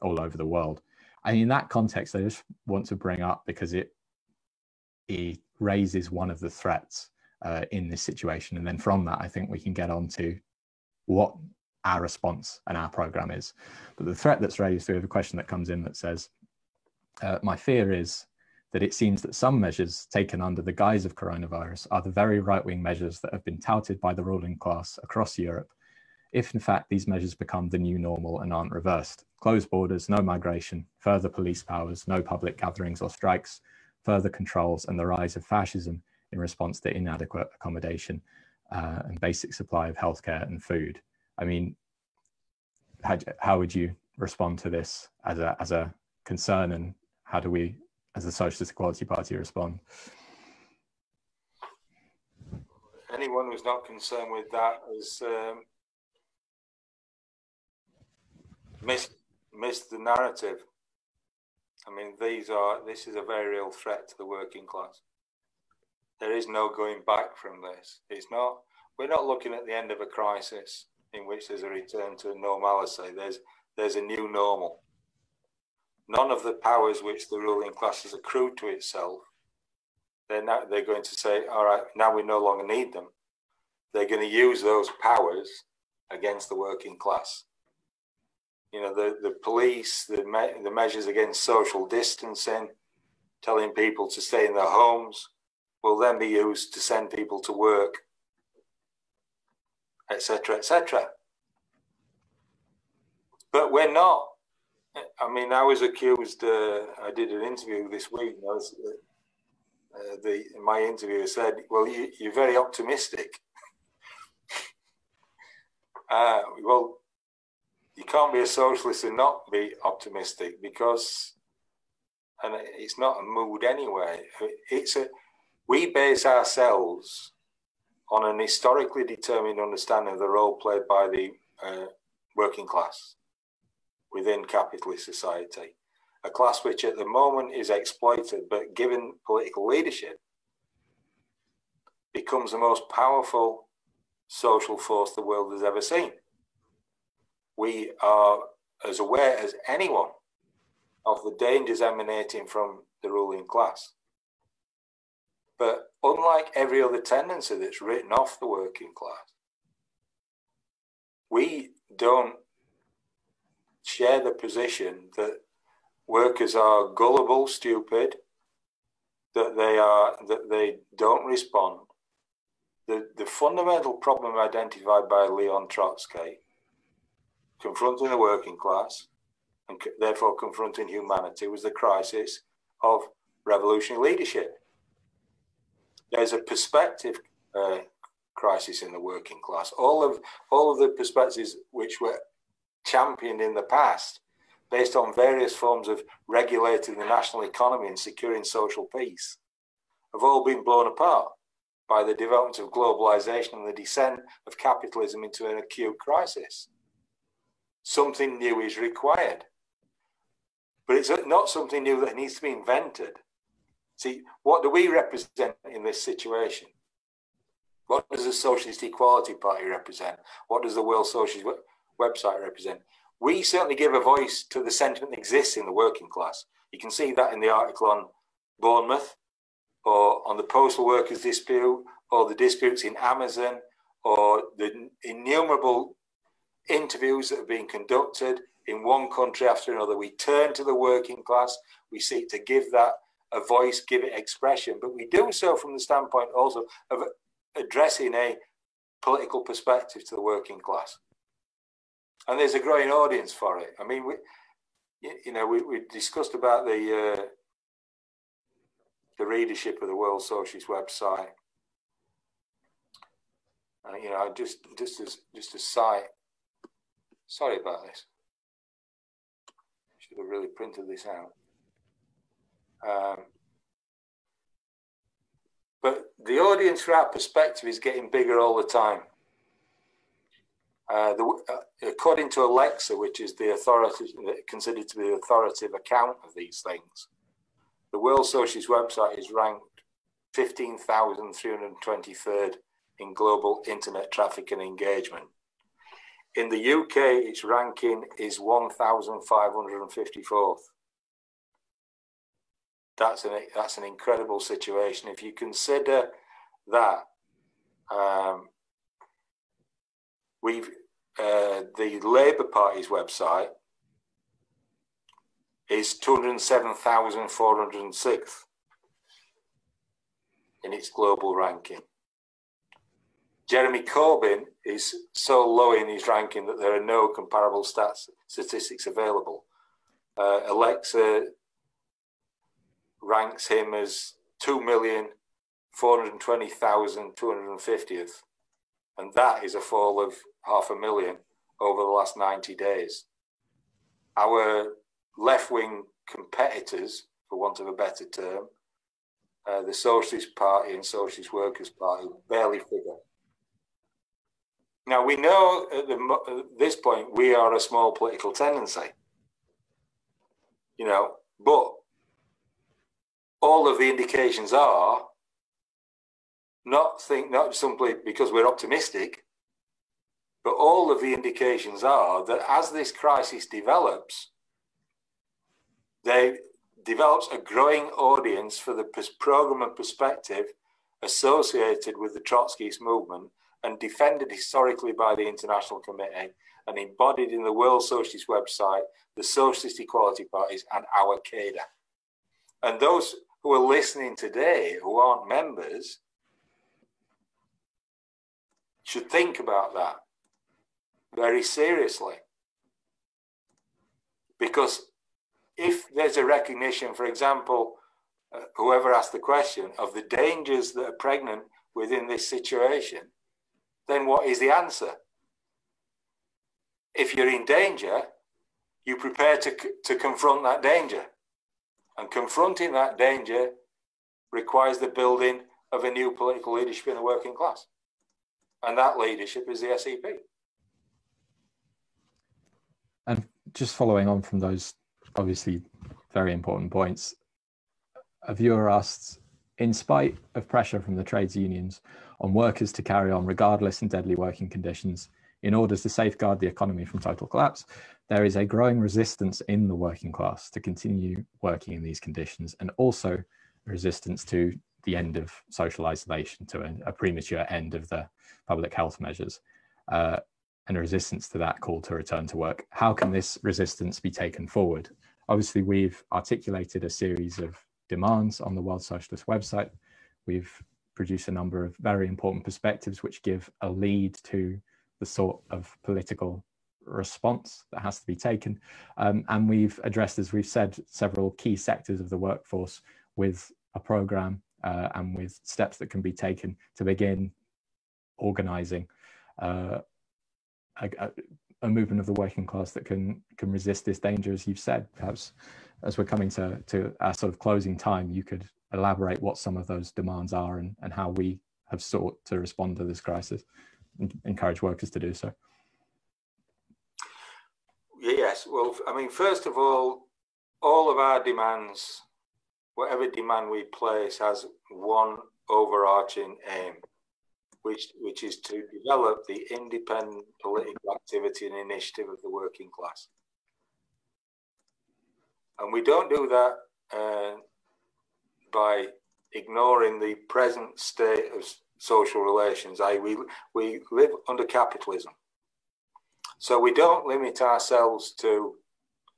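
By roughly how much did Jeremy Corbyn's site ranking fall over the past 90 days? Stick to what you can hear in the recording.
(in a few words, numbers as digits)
half a million.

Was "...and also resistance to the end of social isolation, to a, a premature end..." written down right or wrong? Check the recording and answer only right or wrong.
right.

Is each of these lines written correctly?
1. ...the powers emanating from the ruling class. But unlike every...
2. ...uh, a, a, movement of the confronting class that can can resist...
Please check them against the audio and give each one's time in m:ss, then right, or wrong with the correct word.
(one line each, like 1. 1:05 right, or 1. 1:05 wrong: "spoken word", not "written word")
1. 2:31 wrong: "dangers", not "powers"
2. 8:09 wrong: "working", not "confronting".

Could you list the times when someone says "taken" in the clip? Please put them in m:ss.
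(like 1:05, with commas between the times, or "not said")
0:20, 7:44, 7:58, 8:06.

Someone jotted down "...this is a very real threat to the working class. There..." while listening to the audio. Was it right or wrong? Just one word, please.
right.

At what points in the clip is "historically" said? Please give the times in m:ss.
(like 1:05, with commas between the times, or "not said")
2:08, 6:24.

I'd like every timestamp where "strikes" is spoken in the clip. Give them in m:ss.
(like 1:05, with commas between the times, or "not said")
0:33.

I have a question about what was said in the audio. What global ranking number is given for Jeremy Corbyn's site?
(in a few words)
2,420,250th.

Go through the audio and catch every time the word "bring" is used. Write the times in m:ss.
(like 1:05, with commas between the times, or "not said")
0:02.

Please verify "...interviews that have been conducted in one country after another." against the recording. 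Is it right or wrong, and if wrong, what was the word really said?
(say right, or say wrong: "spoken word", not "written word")
right.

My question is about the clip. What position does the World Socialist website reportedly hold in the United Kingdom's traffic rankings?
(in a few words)
1,554th.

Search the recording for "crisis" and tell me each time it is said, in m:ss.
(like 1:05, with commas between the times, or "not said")
1:10, 3:01, 3:08, 3:25, 6:12, 8:23.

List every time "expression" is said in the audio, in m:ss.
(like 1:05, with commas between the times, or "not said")
4:04.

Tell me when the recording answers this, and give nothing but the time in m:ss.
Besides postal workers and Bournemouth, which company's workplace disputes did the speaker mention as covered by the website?
3:52.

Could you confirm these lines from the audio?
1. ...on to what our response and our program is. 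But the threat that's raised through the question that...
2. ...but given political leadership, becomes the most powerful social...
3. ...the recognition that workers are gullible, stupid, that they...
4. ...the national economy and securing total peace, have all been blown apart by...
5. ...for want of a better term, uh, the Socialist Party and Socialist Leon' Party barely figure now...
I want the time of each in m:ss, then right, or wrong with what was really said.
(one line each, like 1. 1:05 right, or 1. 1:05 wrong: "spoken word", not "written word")
1. 0:09 right
2. 2:18 right
3. 2:44 wrong: "position", not "recognition"
4. 3:16 wrong: "social", not "total"
5. 5:47 wrong: "Workers", not "Leon".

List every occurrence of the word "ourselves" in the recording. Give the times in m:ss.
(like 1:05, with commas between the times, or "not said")
2:06, 8:57.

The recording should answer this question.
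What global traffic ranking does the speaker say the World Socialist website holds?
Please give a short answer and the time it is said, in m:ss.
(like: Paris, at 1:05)
15,323rd, at 4:50.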